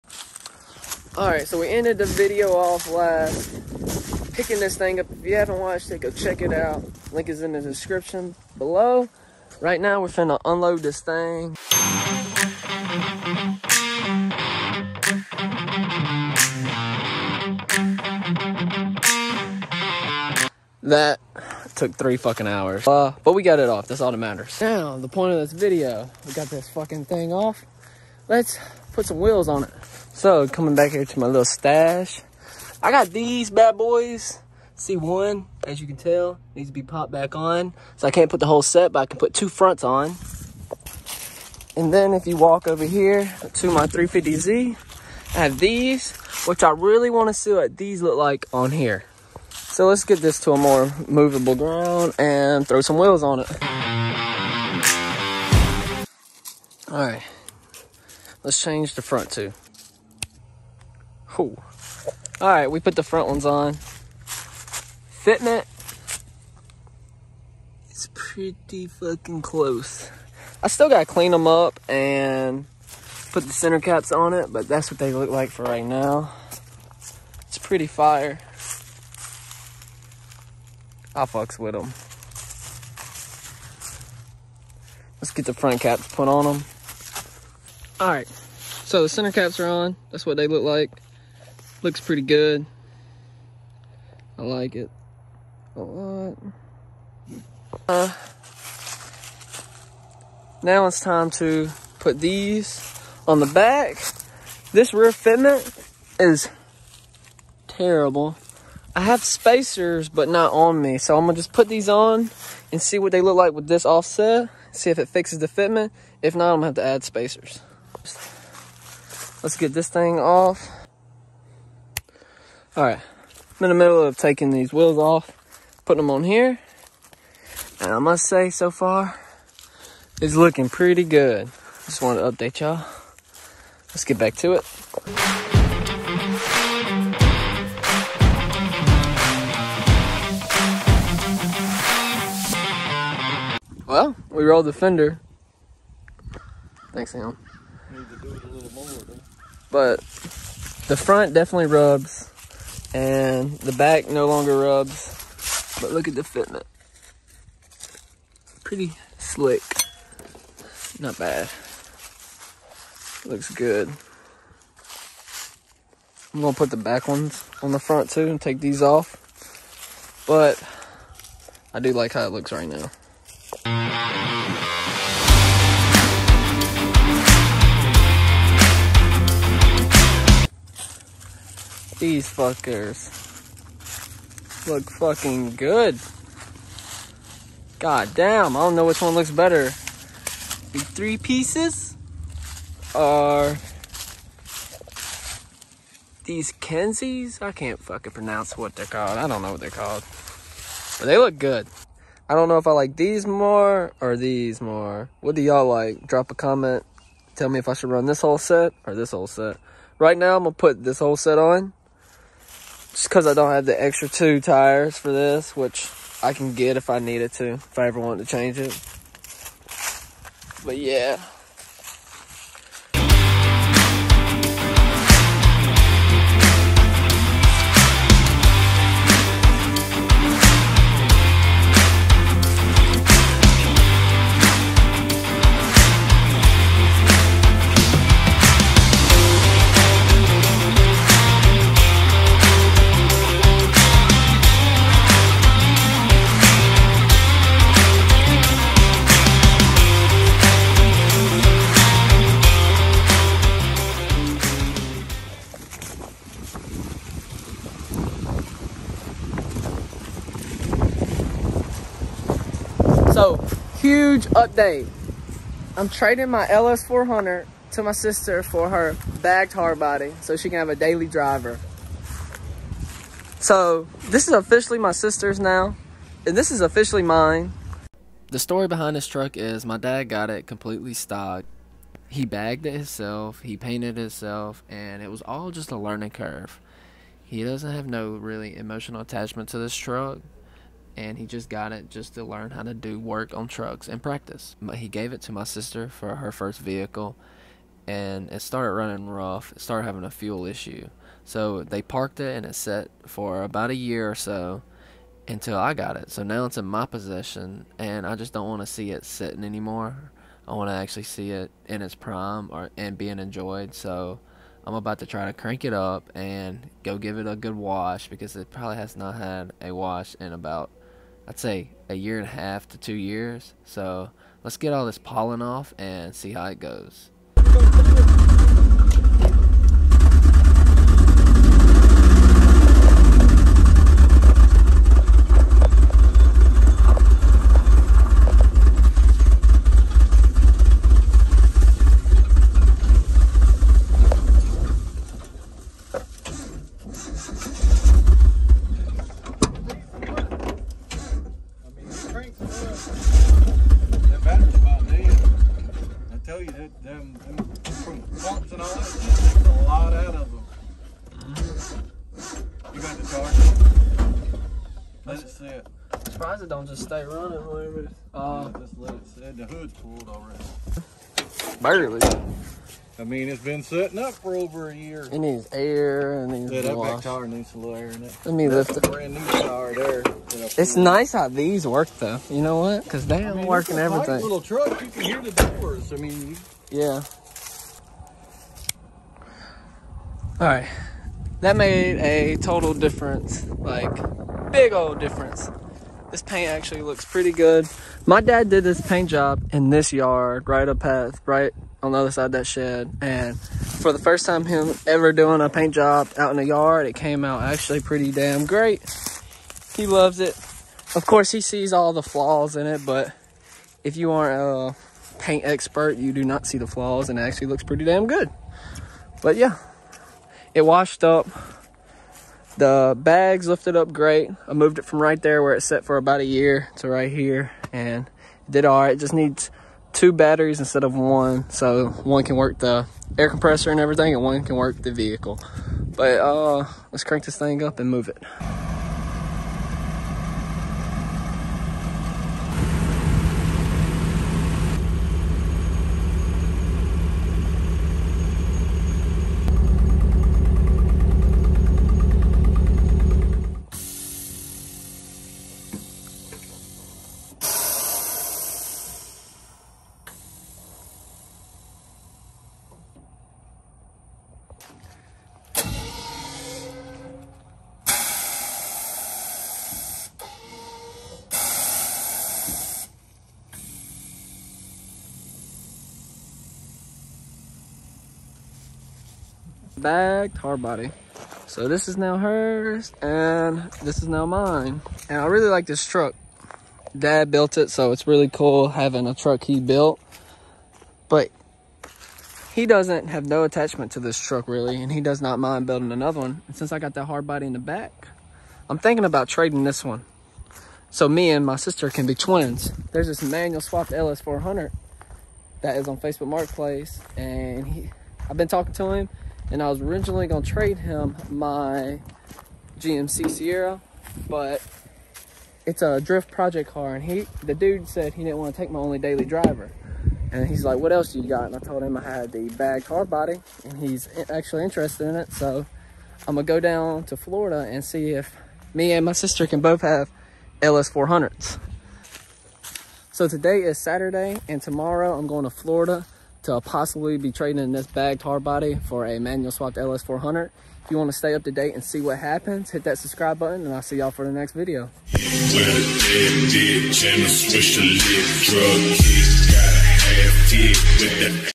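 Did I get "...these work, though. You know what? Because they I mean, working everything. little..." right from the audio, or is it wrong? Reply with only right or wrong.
right.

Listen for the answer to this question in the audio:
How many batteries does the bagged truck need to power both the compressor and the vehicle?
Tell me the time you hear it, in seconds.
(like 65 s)
429 s.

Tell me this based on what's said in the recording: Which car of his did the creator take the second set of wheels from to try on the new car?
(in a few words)
350Z.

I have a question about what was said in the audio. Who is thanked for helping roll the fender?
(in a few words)
Sam.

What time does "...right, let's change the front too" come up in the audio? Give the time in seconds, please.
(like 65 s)
57 s.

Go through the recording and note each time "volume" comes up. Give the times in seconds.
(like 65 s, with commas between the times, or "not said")
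not said.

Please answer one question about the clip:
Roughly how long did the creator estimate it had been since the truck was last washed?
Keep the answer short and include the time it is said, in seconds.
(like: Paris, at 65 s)
A year and a half to two years, at 321 s.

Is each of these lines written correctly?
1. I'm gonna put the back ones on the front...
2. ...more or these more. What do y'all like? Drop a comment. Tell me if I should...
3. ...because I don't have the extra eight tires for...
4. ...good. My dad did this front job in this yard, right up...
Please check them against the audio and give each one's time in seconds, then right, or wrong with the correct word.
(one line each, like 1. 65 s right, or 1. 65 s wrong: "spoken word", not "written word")
1. 166 s right
2. 203 s right
3. 213 s wrong: "two", not "eight"
4. 397 s wrong: "paint", not "front".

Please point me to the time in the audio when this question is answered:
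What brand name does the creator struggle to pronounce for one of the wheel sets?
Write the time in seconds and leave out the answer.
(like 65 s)
196 s.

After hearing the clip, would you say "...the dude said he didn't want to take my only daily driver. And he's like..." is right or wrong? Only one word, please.
right.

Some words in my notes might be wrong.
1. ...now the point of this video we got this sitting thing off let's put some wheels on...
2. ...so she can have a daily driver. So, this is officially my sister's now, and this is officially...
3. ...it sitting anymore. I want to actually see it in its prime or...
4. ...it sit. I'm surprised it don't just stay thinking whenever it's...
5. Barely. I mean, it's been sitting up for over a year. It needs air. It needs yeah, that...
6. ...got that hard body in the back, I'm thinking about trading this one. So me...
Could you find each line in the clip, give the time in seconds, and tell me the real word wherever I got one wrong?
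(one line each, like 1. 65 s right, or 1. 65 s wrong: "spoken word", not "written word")
1. 24 s wrong: "fucking", not "sitting"
2. 270 s right
3. 308 s right
4. 365 s wrong: "running", not "thinking"
5. 371 s right
6. 496 s right.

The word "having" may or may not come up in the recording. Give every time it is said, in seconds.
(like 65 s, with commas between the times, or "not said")
299 s, 488 s.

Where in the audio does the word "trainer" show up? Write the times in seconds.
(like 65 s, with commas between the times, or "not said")
not said.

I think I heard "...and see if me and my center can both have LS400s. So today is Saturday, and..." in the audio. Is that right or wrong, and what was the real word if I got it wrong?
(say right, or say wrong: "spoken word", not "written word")
wrong: "sister", not "center".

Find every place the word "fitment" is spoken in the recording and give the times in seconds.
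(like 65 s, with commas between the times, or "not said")
64 s, 105 s, 115 s, 156 s.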